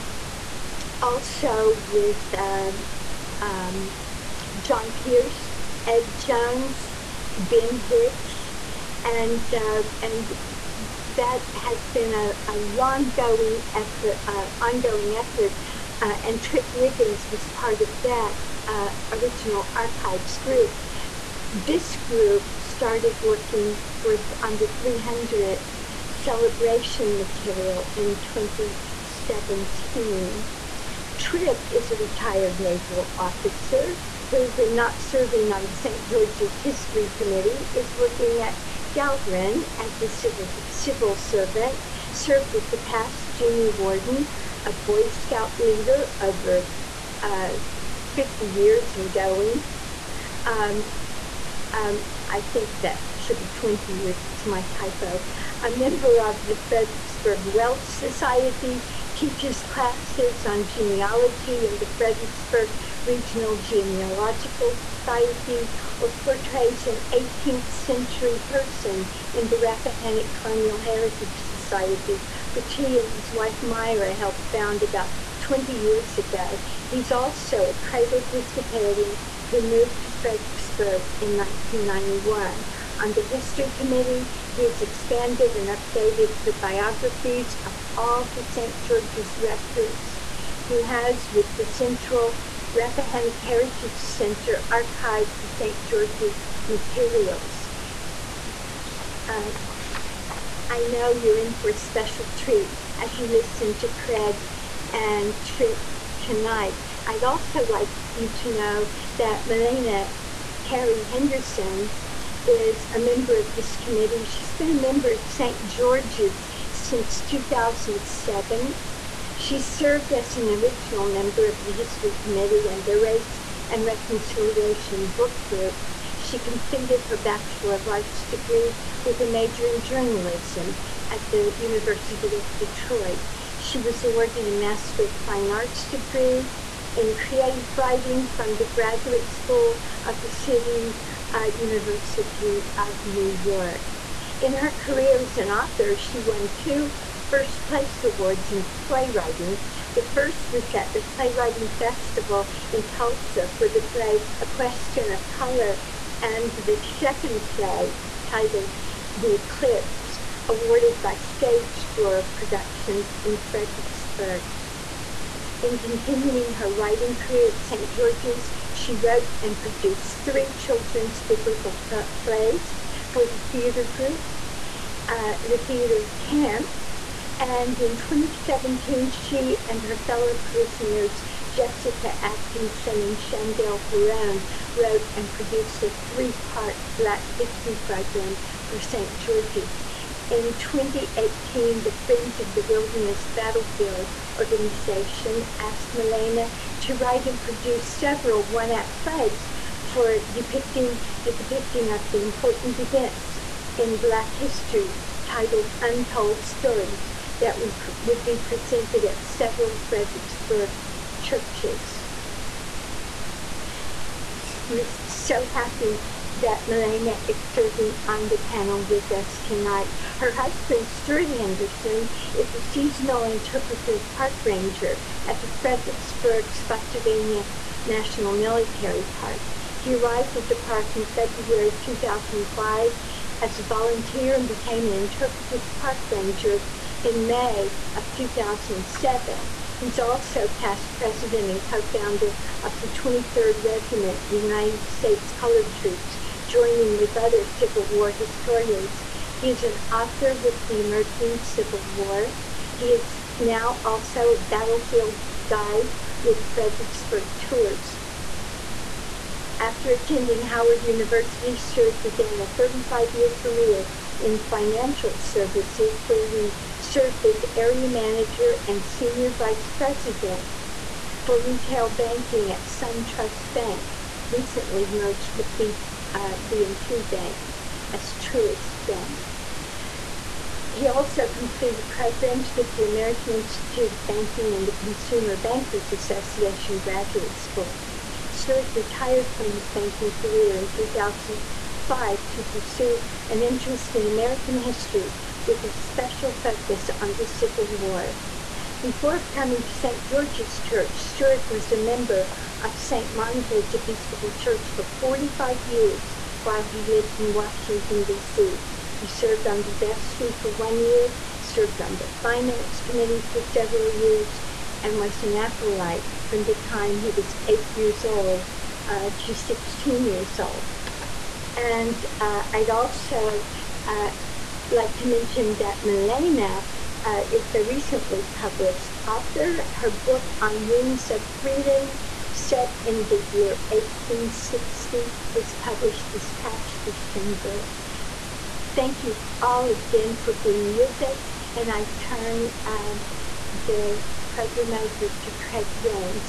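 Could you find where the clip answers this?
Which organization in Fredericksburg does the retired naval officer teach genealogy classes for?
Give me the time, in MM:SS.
01:01.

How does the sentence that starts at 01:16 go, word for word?
He's also a cradle Episcopalian who moved to Fredericksburg in 1991 on the History Committee.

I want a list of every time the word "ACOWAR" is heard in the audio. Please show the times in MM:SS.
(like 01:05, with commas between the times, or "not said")
not said.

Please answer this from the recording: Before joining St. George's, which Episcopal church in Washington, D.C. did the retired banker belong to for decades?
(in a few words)
St. Monica's Episcopal Church.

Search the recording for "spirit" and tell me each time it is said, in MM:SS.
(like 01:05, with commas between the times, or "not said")
not said.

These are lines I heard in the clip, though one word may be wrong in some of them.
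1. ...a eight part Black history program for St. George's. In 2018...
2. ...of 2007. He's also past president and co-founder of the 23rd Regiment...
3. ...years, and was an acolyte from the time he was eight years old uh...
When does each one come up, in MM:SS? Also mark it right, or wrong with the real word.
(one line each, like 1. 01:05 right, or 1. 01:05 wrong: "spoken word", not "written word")
1. 03:05 wrong: "three", not "eight"
2. 03:57 right
3. 05:13 right.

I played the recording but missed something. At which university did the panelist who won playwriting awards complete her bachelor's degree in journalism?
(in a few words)
University of Detroit.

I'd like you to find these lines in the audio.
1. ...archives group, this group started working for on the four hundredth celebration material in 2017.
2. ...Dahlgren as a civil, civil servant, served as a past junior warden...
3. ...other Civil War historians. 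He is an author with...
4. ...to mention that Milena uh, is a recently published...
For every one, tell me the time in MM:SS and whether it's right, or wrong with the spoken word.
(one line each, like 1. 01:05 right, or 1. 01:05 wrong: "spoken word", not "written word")
1. 00:19 wrong: "three", not "four"
2. 00:38 right
3. 04:07 right
4. 05:24 right.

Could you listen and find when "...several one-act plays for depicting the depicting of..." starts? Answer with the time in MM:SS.
03:17.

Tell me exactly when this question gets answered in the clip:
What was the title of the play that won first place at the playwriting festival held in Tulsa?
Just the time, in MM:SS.
02:34.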